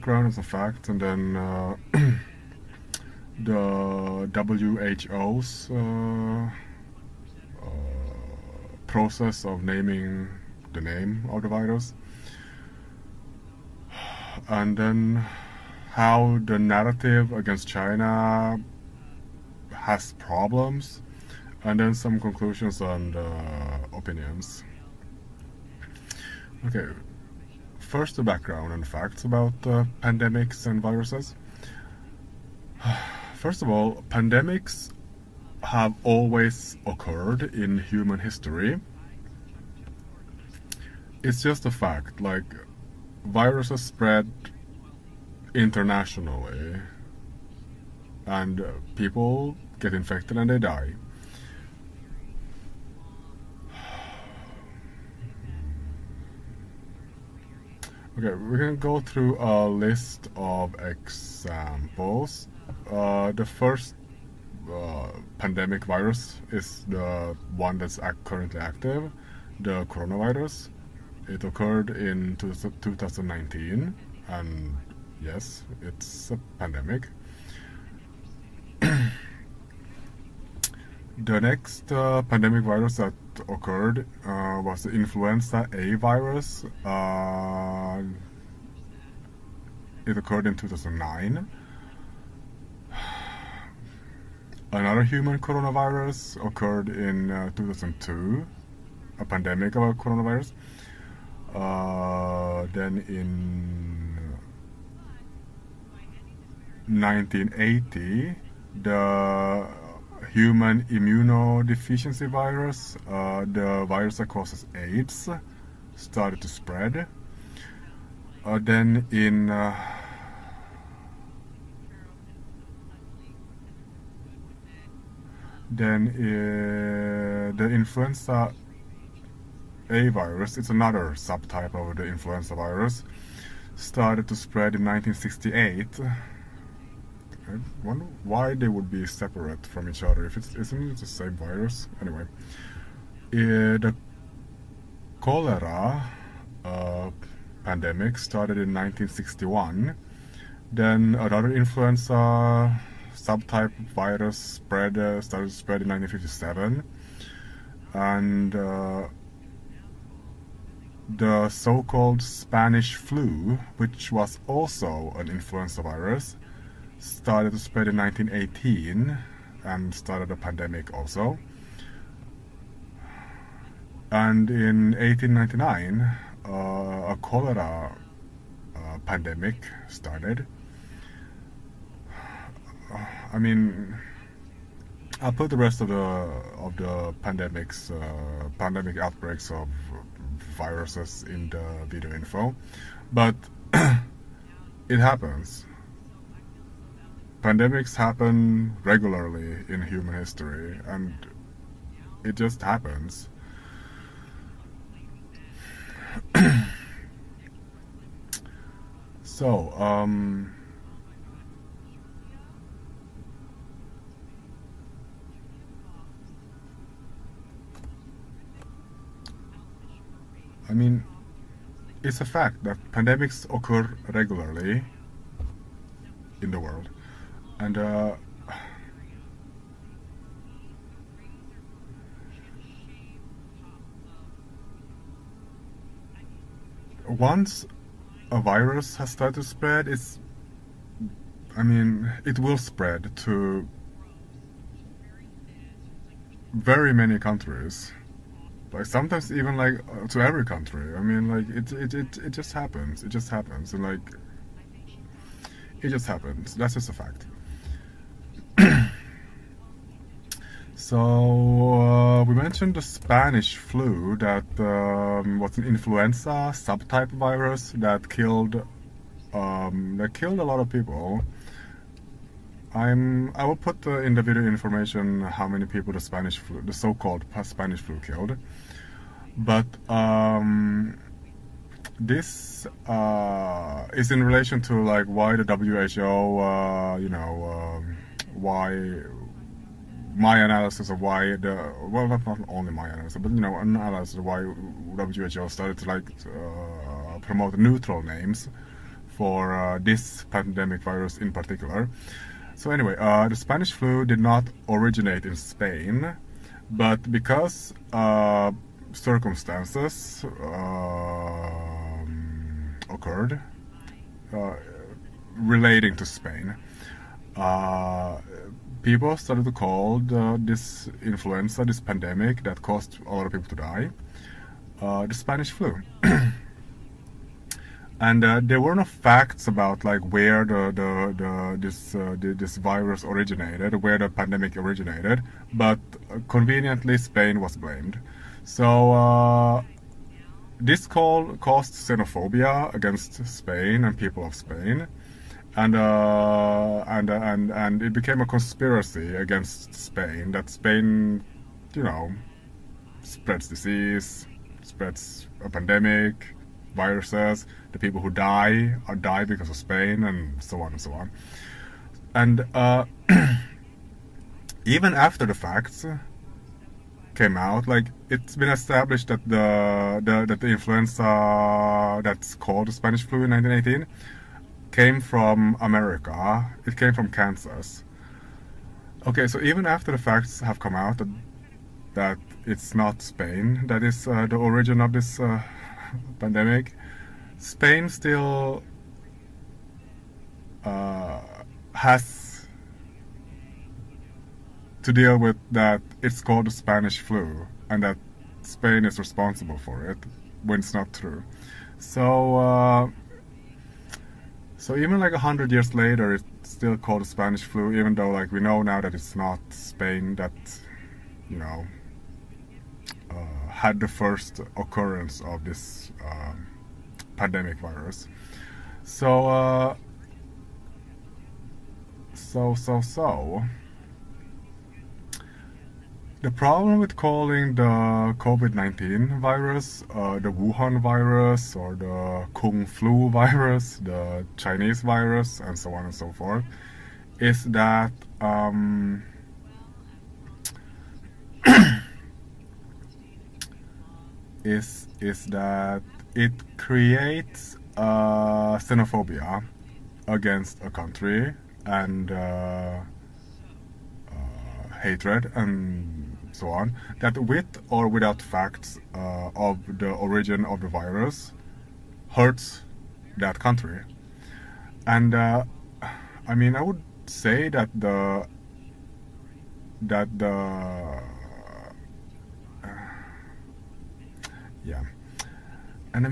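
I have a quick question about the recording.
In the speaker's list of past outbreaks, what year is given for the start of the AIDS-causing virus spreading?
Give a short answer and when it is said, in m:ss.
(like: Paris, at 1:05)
1980, at 1:46.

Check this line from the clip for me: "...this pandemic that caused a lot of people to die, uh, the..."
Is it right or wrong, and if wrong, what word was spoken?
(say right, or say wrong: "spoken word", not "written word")
right.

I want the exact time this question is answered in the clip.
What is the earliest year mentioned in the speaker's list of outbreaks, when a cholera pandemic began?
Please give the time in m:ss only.
2:54.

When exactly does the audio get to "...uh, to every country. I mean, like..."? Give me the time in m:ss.
4:09.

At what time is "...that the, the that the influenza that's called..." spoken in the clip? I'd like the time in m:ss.
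6:09.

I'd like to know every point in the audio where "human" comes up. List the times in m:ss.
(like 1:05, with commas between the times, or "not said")
0:37, 1:35, 1:50, 3:19.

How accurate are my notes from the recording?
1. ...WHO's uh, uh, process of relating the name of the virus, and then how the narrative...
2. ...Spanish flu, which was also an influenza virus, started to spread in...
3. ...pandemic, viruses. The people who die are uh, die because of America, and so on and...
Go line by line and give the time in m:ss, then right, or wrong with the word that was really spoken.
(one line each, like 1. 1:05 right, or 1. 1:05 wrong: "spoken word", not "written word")
1. 0:05 wrong: "naming", not "relating"
2. 2:42 right
3. 5:55 wrong: "Spain", not "America".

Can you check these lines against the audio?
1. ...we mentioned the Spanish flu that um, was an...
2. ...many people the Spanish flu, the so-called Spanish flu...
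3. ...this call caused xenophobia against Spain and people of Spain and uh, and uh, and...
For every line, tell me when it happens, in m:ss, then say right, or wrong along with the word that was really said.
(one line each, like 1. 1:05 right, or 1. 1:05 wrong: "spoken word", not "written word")
1. 4:22 right
2. 4:35 right
3. 5:40 right.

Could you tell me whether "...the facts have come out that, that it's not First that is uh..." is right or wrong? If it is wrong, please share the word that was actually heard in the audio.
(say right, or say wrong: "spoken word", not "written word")
wrong: "Spain", not "First".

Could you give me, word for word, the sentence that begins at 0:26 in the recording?
Okay, first the background and facts about uh, pandemics and viruses.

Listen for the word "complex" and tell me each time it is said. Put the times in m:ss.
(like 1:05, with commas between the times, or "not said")
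not said.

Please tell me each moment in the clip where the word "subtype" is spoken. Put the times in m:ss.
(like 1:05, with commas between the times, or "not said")
2:11, 2:33, 4:26.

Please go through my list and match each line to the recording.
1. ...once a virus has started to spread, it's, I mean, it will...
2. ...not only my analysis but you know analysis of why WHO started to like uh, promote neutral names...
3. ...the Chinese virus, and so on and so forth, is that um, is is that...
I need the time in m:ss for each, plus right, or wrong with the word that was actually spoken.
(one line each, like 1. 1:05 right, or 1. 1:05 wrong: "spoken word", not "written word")
1. 3:57 right
2. 4:52 right
3. 7:13 right.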